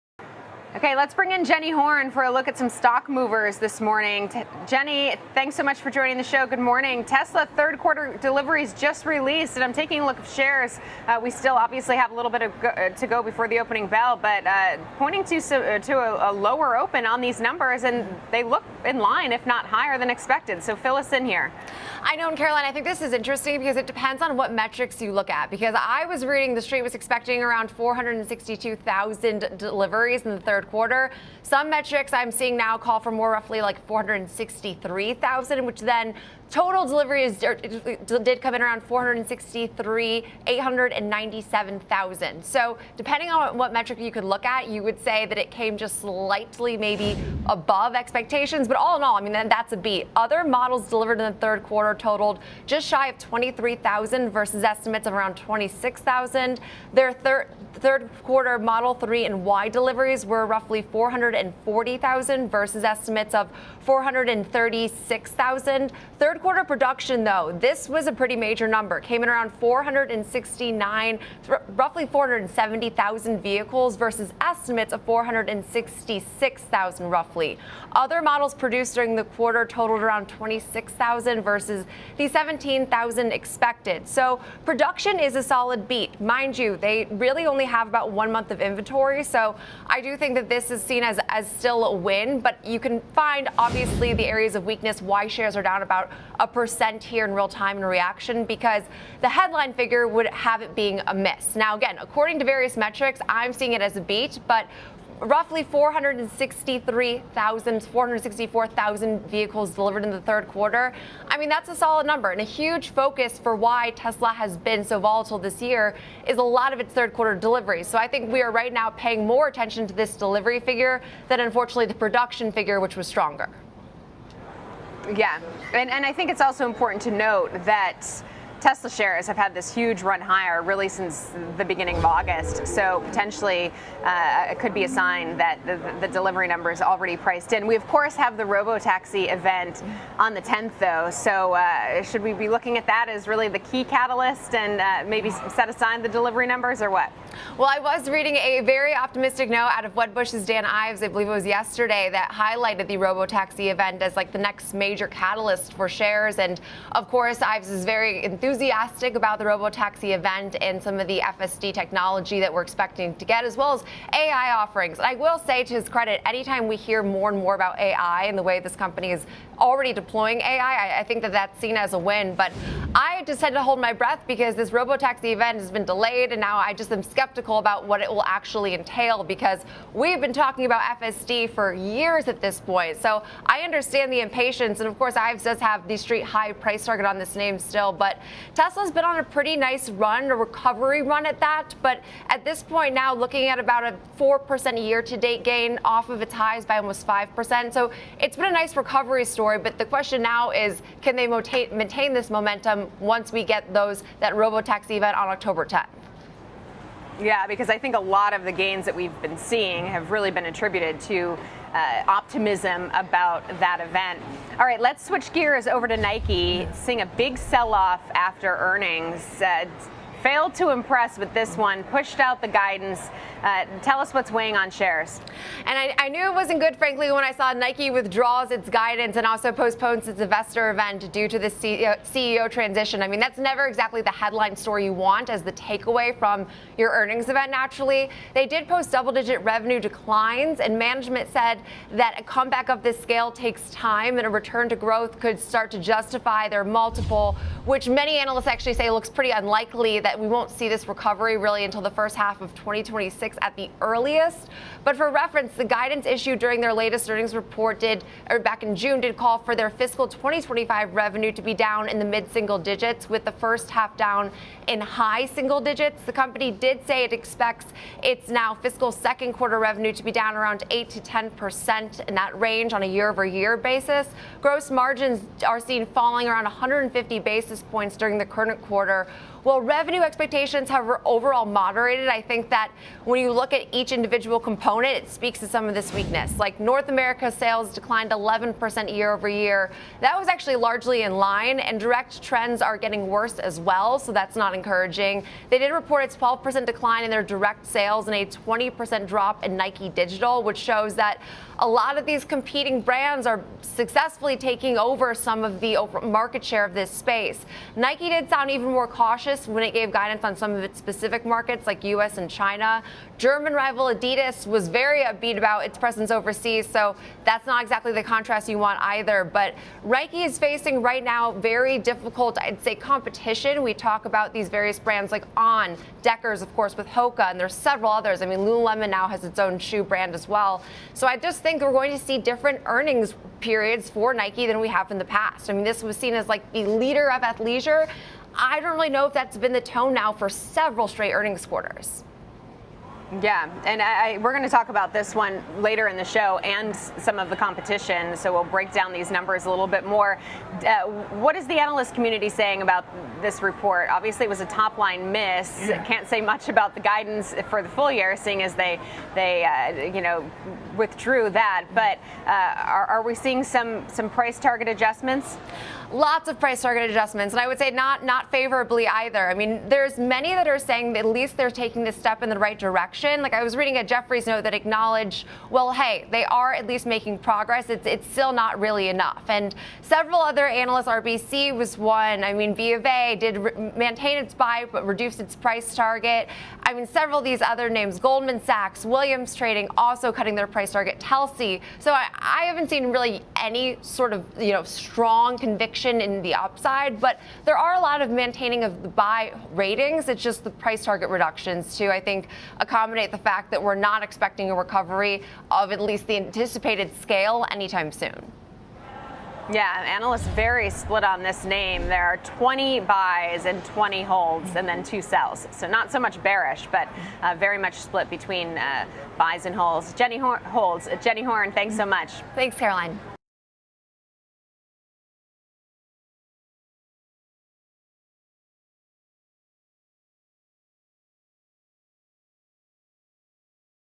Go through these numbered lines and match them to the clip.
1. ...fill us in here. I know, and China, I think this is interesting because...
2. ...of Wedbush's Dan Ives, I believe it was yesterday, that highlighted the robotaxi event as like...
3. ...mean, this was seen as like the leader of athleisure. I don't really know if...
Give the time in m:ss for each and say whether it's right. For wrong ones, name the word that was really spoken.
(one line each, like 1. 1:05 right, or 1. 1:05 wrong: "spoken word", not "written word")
1. 0:20 wrong: "Caroline", not "China"
2. 2:29 right
3. 5:35 right.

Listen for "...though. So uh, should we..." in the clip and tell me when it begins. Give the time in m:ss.
2:20.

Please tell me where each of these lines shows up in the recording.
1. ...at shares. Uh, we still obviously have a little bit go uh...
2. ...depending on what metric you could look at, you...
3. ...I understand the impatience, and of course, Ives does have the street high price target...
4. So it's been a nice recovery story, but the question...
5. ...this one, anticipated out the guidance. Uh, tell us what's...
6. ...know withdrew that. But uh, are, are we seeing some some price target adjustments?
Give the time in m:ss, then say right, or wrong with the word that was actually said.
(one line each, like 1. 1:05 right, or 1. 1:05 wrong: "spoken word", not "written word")
1. 0:10 right
2. 0:42 right
3. 3:03 right
4. 3:17 right
5. 3:41 wrong: "pushed", not "anticipated"
6. 5:59 right.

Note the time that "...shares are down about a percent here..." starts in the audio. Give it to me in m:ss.
1:35.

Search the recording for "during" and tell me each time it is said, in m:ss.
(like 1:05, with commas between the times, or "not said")
1:18, 4:16, 4:37.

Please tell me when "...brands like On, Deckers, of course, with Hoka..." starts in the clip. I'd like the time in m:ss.
5:24.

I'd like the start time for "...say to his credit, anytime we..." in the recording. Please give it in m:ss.
2:45.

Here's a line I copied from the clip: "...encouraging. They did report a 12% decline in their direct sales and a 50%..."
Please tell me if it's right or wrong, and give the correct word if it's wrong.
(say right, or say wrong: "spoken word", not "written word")
wrong: "20", not "50".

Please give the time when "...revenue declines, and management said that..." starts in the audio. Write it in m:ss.
3:59.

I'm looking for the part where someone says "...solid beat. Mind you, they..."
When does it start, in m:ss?
1:25.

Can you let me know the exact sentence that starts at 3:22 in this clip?
once we get those that RoboTaxi event on October 10th.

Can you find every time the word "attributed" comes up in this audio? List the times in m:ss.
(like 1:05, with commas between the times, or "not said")
3:30.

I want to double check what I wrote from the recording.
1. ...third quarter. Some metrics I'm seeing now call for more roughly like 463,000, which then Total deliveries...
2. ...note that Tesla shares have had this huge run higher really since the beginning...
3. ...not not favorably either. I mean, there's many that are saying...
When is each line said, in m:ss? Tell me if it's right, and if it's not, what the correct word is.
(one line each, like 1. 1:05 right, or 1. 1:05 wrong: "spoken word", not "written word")
1. 0:30 right
2. 2:07 right
3. 6:07 right.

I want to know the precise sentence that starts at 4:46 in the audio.
Like North America sales declined 11% year over year.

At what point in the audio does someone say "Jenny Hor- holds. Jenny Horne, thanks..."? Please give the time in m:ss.
6:59.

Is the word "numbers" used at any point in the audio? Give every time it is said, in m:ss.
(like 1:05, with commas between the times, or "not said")
0:17, 1:08, 1:52, 2:16, 2:26, 5:49.